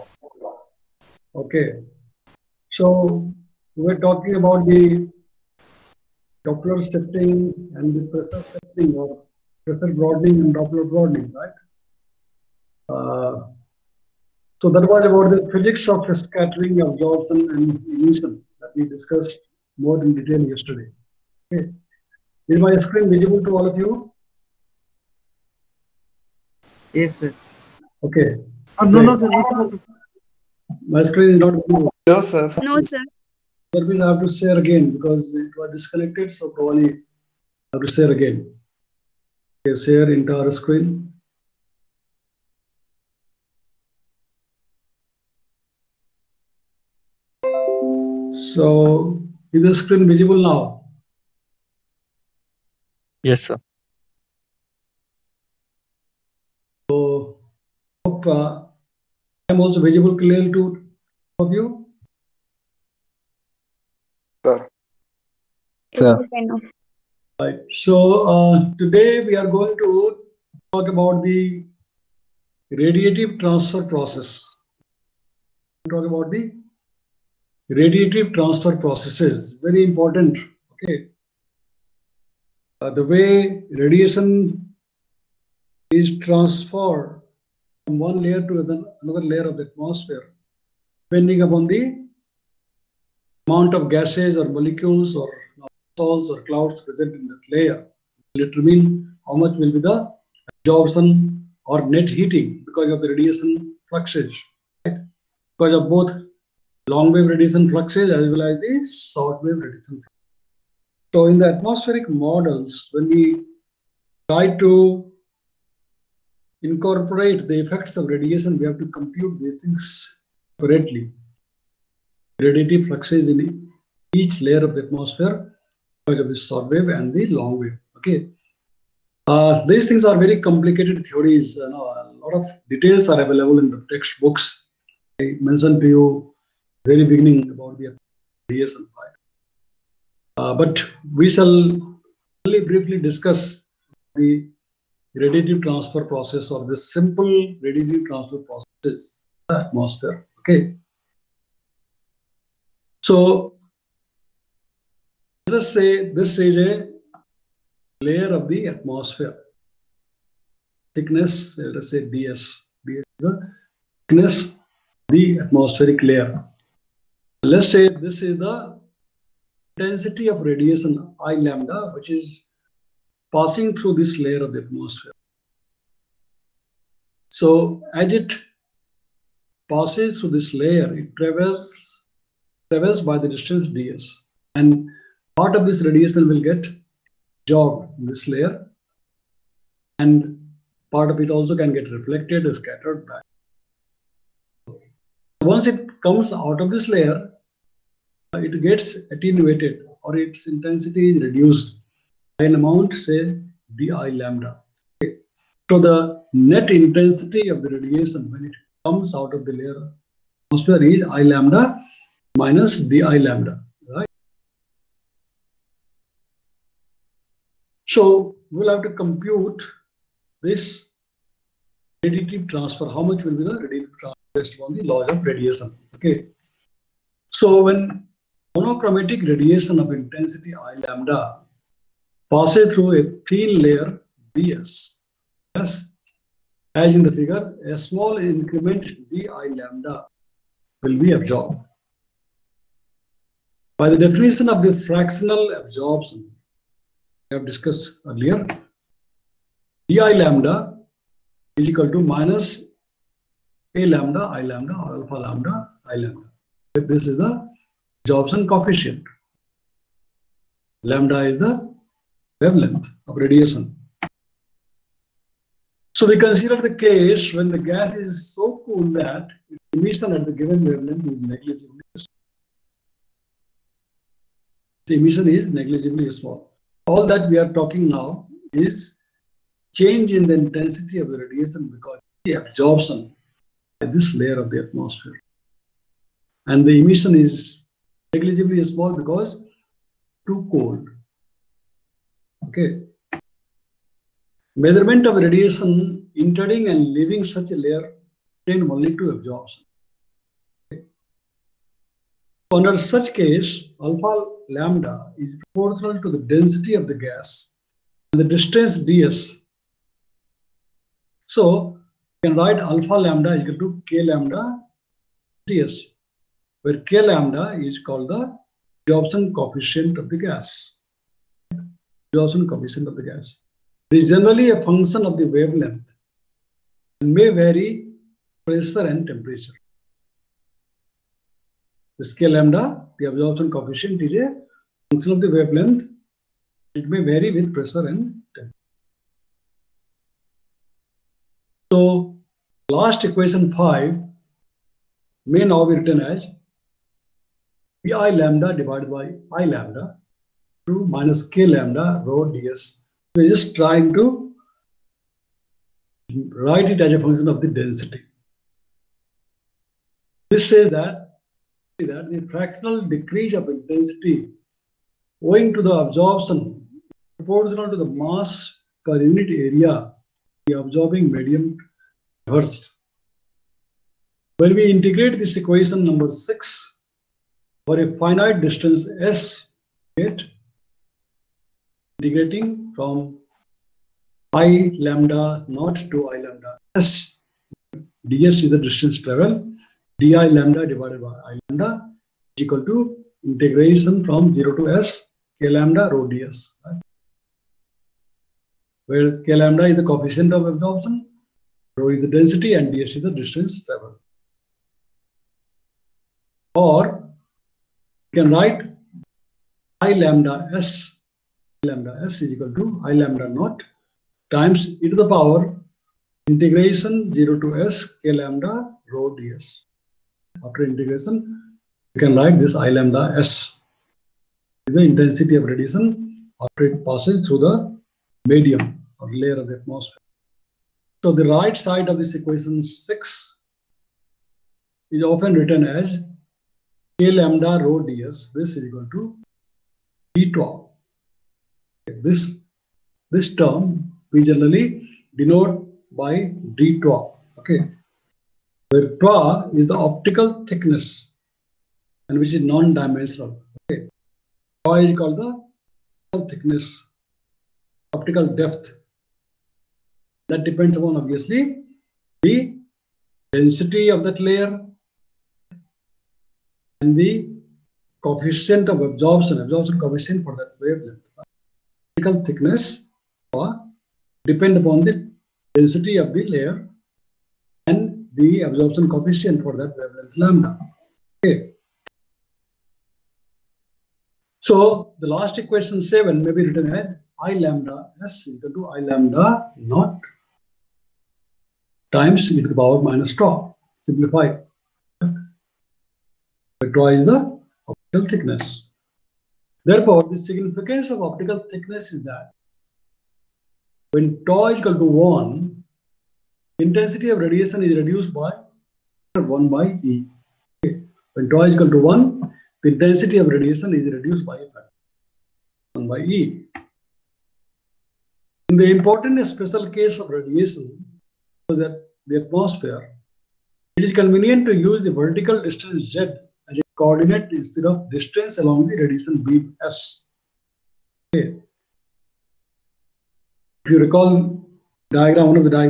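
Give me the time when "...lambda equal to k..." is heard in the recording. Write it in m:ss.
5:12.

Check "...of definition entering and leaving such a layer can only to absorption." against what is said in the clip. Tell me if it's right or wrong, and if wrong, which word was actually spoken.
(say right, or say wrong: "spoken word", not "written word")
wrong: "radiation", not "definition".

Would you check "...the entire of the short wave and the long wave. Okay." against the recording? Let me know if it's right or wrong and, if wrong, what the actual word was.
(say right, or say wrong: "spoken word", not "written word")
wrong: "atmosphere", not "entire".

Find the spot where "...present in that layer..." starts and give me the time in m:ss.
1:36.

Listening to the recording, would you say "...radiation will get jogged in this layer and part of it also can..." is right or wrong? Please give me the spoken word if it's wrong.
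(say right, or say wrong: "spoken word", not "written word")
right.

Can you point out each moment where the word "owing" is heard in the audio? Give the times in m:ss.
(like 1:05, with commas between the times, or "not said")
6:05.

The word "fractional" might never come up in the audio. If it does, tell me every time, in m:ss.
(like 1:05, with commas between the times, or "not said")
4:04, 6:02.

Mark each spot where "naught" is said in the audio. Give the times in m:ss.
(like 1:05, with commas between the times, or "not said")
6:25, 6:53, 8:09.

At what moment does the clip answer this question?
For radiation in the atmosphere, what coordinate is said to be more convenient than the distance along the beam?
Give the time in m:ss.
8:44.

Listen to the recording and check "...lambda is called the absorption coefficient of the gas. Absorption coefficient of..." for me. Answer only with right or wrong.
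right.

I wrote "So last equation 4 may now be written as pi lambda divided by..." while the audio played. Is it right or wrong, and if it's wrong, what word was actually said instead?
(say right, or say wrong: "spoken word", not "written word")
wrong: "5", not "4".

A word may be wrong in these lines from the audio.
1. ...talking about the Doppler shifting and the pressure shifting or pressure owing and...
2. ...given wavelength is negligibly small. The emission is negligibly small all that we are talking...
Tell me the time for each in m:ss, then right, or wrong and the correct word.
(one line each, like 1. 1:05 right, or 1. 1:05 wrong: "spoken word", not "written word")
1. 0:03 wrong: "broadening", not "owing"
2. 4:30 right.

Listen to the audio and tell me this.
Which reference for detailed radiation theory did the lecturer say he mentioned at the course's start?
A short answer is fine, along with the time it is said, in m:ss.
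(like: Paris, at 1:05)
DSM 5, at 2:18.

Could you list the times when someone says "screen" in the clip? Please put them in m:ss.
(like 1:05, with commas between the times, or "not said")
0:22, 0:31, 0:40, 0:49.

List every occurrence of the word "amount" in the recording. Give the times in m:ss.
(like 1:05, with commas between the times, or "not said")
1:33, 3:22.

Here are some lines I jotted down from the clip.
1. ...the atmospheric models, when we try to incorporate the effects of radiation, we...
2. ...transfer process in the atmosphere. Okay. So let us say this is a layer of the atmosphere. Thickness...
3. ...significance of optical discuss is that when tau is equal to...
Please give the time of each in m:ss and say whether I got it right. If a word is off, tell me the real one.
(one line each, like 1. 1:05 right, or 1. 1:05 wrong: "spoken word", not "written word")
1. 1:51 right
2. 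2:28 right
3. 8:20 wrong: "thickness", not "discuss".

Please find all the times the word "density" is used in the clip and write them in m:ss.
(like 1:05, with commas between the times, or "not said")
2:49, 5:06, 5:57, 6:42, 7:43, 7:55.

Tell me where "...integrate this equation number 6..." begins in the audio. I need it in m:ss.
6:14.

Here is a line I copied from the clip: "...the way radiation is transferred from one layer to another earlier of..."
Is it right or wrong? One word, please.
wrong.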